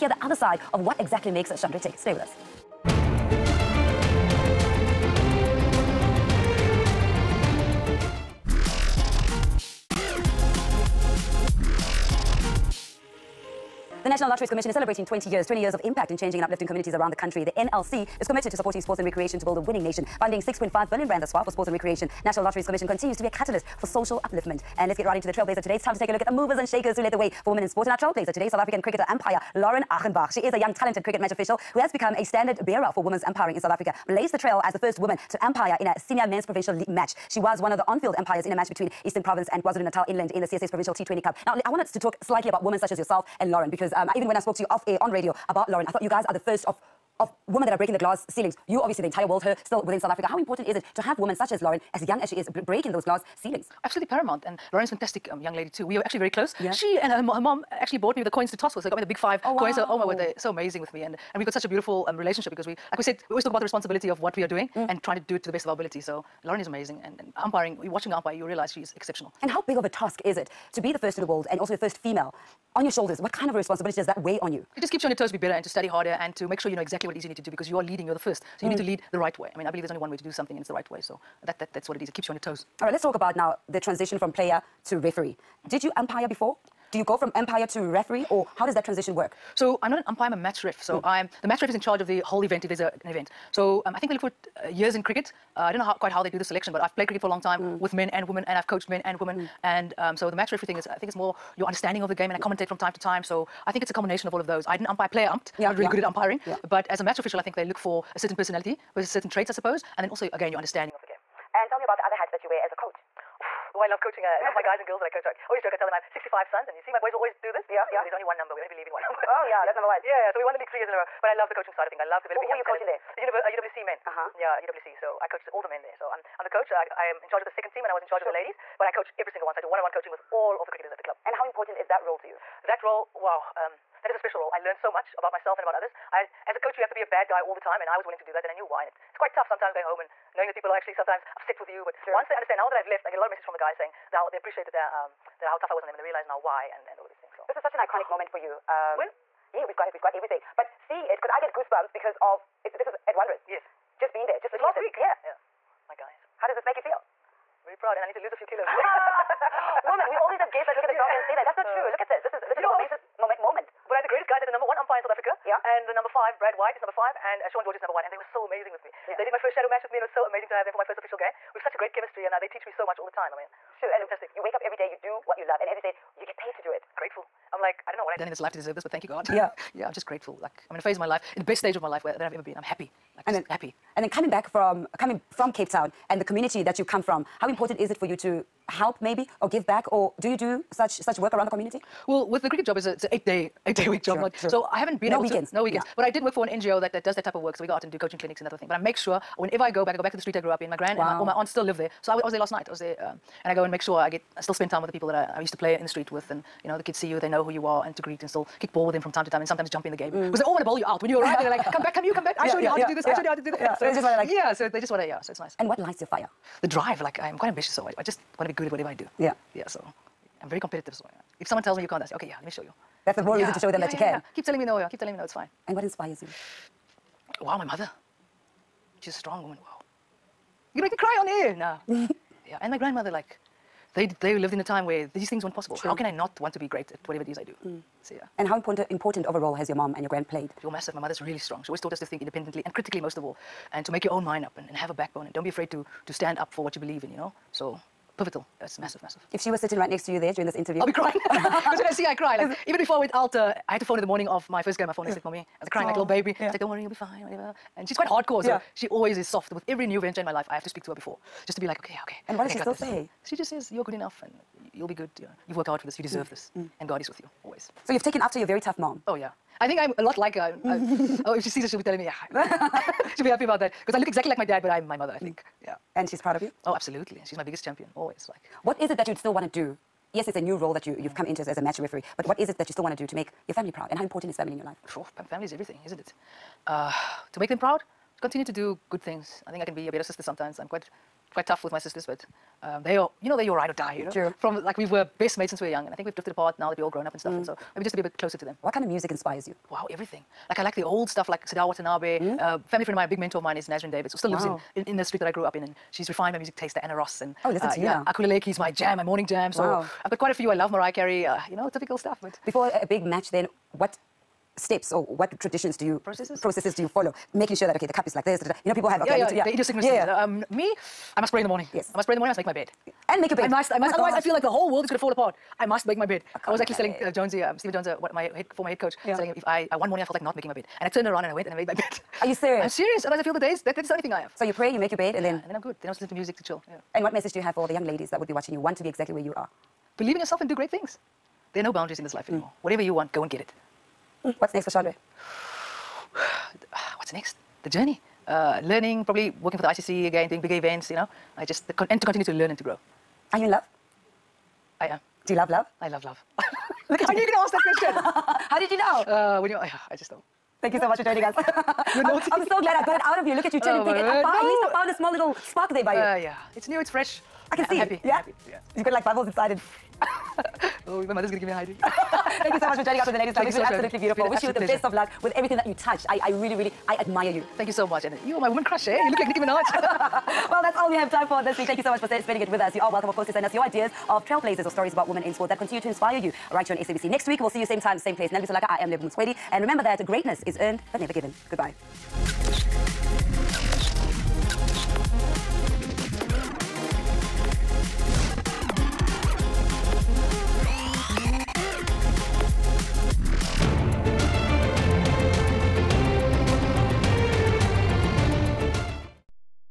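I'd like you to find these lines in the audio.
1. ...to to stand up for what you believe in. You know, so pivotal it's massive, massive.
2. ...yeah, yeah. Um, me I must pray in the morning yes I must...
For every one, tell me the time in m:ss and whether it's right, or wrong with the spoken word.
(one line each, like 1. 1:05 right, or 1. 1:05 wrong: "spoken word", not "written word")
1. 4:05 right
2. 5:19 right.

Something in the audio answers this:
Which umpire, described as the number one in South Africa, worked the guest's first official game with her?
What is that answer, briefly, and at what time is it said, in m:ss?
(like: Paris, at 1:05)
Shaun George, at 2:47.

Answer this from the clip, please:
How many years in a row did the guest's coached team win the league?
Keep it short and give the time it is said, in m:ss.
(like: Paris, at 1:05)
3, at 2:00.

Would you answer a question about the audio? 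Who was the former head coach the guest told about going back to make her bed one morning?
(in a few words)
Stephen Jones.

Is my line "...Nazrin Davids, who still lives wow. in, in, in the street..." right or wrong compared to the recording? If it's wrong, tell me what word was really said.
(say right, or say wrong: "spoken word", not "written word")
right.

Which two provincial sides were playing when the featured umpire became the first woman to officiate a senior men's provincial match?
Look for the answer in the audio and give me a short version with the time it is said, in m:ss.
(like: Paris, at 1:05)
Eastern Province and KwaZulu-Natal Inland, at 0:39.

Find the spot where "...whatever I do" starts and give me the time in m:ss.
3:38.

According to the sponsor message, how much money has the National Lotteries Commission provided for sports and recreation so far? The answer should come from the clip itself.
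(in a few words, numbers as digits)
6.5 billion rand.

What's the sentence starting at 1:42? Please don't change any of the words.
commentate from time to time, so I think it's a combination of all of those.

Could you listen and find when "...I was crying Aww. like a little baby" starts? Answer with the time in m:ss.
4:15.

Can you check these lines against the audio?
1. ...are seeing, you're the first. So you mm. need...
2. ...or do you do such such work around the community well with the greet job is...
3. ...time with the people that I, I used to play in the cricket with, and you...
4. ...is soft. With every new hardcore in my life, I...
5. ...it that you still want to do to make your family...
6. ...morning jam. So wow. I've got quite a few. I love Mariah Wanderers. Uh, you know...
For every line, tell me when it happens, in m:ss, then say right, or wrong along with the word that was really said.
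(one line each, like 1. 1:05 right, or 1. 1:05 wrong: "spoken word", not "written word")
1. 1:17 wrong: "leading", not "seeing"
2. 3:09 wrong: "cricket", not "greet"
3. 3:24 wrong: "street", not "cricket"
4. 4:19 wrong: "venture", not "hardcore"
5. 4:42 right
6. 5:09 wrong: "Carey", not "Wanderers".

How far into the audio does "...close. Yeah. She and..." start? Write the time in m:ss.
0:56.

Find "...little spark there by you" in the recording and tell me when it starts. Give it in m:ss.
6:05.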